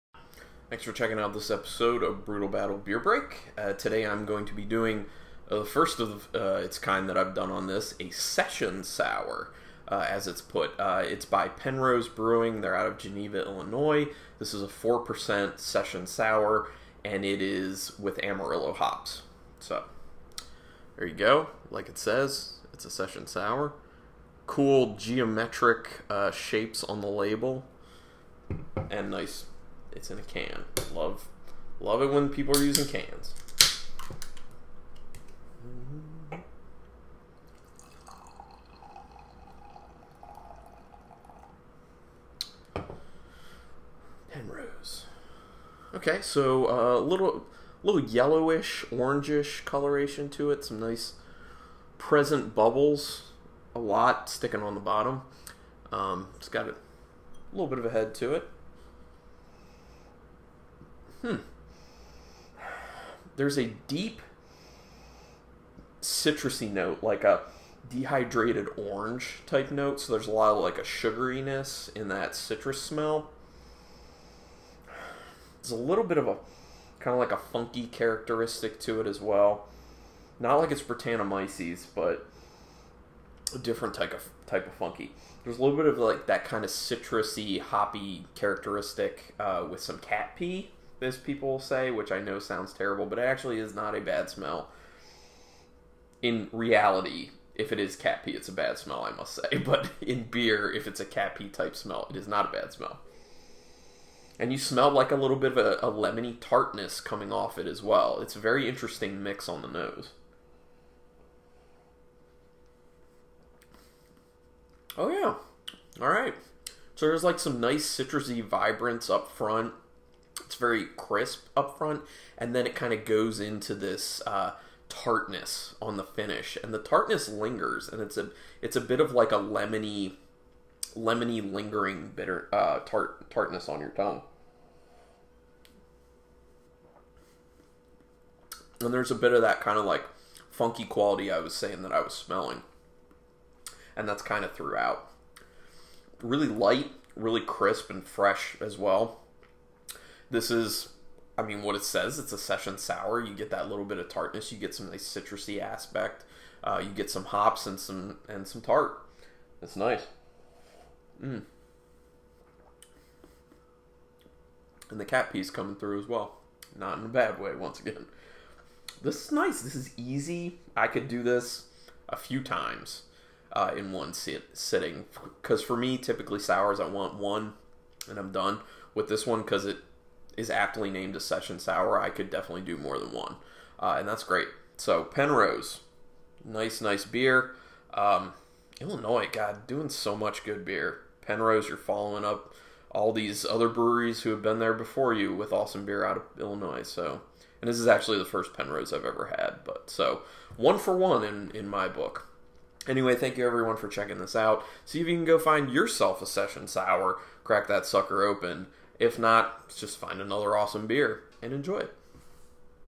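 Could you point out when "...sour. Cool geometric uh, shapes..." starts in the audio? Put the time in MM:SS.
00:23.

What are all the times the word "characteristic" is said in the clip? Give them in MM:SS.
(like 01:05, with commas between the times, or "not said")
01:17, 01:28.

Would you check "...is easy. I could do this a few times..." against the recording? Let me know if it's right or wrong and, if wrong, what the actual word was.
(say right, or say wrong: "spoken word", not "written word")
right.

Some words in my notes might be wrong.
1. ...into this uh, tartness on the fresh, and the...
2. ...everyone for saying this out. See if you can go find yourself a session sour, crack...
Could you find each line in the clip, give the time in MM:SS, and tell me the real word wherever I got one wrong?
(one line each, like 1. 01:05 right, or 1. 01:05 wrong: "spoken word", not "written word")
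1. 02:03 wrong: "finish", not "fresh"
2. 03:23 wrong: "checking", not "saying".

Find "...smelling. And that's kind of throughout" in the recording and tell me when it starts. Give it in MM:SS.
02:22.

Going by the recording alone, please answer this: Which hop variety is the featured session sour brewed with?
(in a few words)
Amarillo.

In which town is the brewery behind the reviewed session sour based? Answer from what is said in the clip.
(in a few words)
Geneva, Illinois.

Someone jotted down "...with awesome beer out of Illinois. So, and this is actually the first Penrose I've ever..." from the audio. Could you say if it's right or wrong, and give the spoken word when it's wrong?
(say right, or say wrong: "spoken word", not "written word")
right.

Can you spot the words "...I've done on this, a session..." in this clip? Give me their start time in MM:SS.
00:07.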